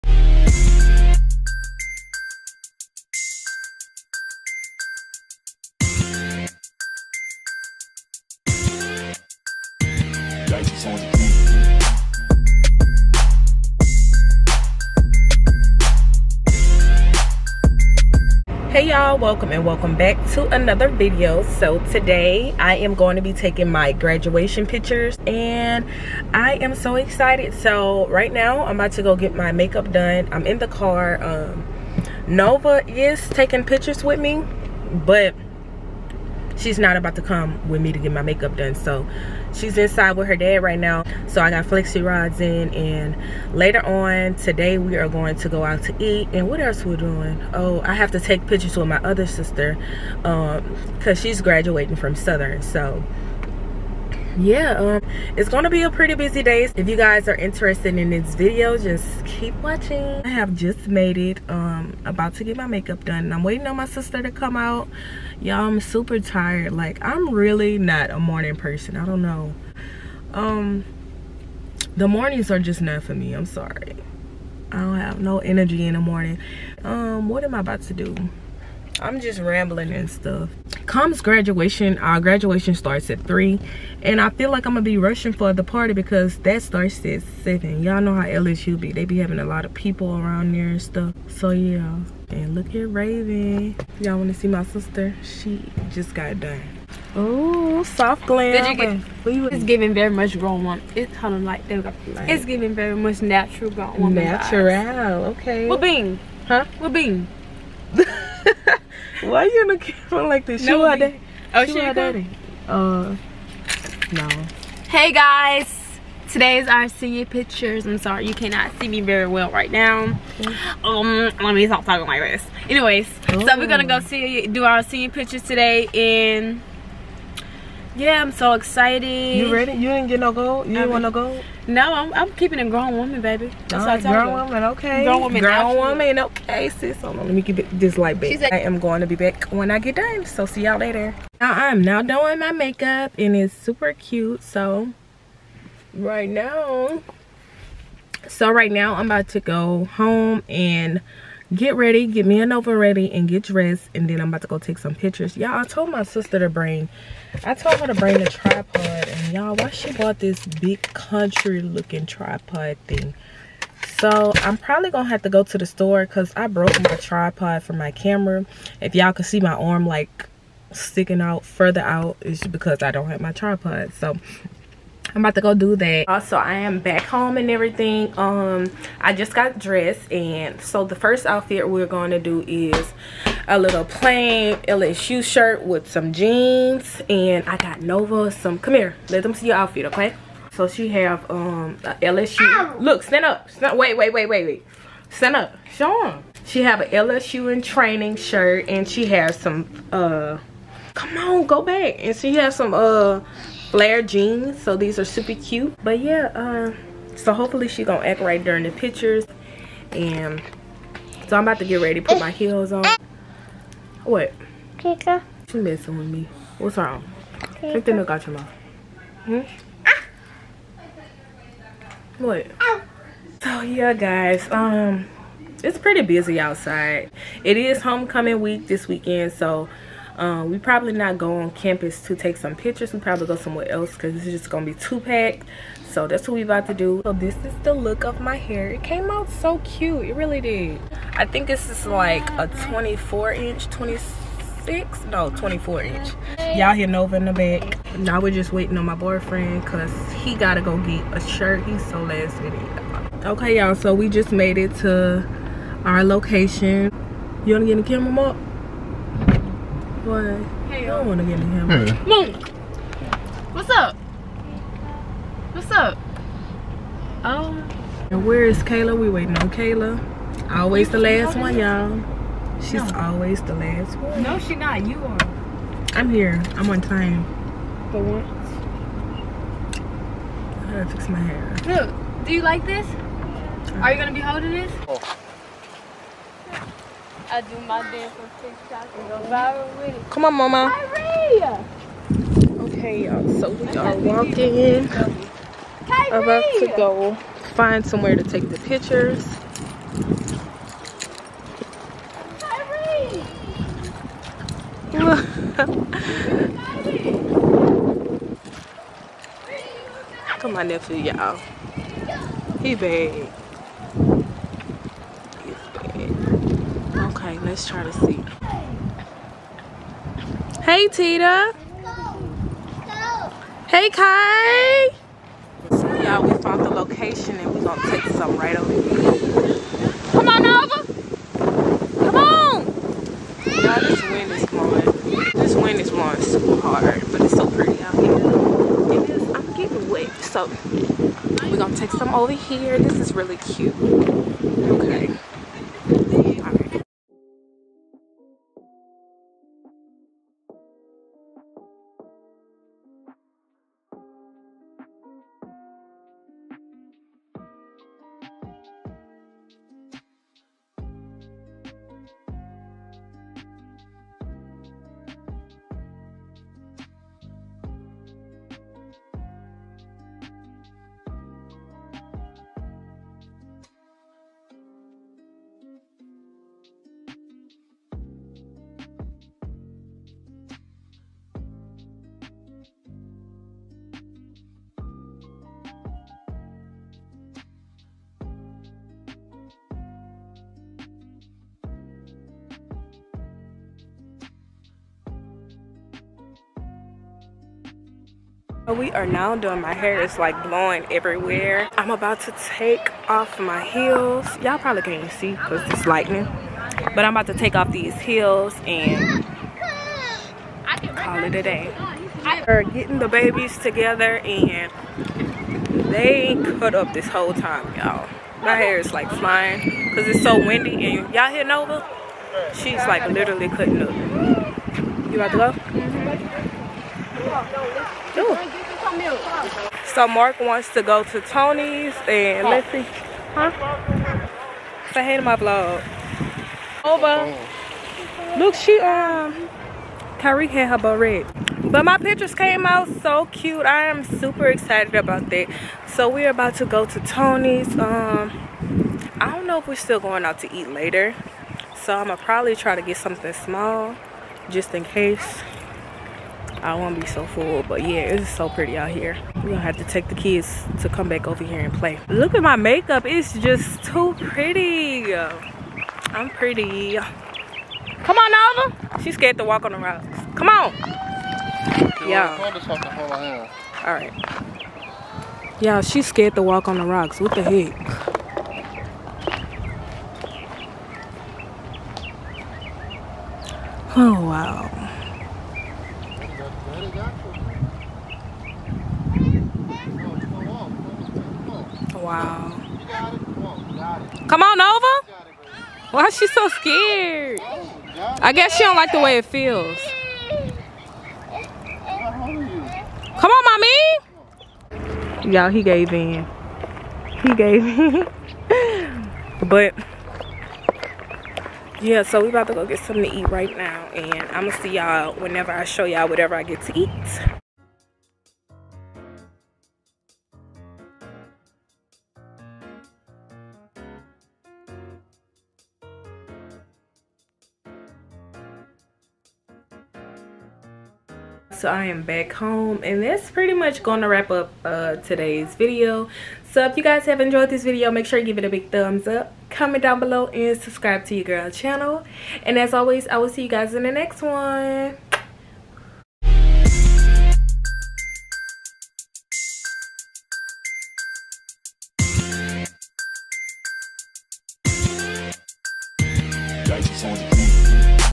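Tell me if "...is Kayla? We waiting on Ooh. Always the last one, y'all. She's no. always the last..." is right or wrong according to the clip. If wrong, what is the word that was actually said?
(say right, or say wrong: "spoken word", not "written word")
wrong: "Kayla", not "Ooh".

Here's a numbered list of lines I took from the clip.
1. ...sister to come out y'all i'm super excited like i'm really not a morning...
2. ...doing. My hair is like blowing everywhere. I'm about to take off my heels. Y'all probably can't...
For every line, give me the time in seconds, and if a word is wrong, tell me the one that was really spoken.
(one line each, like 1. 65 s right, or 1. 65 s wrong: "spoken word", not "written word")
1. 63 s wrong: "tired", not "excited"
2. 399 s right.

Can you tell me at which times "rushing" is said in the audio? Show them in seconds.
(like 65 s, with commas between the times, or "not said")
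84 s.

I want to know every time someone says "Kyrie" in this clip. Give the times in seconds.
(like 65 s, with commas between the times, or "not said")
290 s, 295 s.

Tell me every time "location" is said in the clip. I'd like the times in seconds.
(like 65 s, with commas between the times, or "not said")
256 s, 326 s.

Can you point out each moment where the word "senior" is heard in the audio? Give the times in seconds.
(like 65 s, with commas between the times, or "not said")
116 s, 124 s.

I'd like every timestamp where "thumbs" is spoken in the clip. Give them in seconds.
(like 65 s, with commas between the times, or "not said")
538 s.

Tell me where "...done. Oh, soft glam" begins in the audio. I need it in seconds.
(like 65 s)
96 s.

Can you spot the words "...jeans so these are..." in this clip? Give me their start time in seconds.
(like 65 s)
204 s.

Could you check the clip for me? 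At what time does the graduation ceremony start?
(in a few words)
3.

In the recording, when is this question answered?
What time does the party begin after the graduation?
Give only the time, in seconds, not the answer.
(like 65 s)
86 s.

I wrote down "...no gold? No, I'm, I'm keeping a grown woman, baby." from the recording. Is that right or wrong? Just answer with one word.
right.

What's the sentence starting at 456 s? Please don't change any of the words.
I won't be so full, but yeah, it's so pretty out here.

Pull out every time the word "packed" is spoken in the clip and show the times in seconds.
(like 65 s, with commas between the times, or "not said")
234 s.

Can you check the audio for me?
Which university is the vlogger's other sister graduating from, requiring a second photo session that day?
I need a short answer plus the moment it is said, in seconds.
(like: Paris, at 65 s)
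Southern, at 52 s.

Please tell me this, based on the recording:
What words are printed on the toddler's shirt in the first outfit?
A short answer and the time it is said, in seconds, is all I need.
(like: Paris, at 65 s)
LSU in training, at 196 s.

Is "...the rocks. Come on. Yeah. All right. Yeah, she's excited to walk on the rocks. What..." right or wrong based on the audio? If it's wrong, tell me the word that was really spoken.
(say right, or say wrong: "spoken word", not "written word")
wrong: "scared", not "excited".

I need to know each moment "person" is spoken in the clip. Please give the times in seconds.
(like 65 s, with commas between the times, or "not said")
68 s.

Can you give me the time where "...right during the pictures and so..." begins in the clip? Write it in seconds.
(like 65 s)
208 s.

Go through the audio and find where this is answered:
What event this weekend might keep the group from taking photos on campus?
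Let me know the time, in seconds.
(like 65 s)
227 s.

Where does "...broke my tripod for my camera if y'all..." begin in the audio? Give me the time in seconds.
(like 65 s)
166 s.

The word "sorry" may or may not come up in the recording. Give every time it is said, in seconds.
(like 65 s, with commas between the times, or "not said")
73 s, 117 s.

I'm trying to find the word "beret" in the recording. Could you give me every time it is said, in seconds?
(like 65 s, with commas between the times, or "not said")
440 s.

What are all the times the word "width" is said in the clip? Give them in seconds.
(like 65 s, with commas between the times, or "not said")
not said.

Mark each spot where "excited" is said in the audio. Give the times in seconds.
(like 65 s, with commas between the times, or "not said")
26 s, 128 s, 444 s.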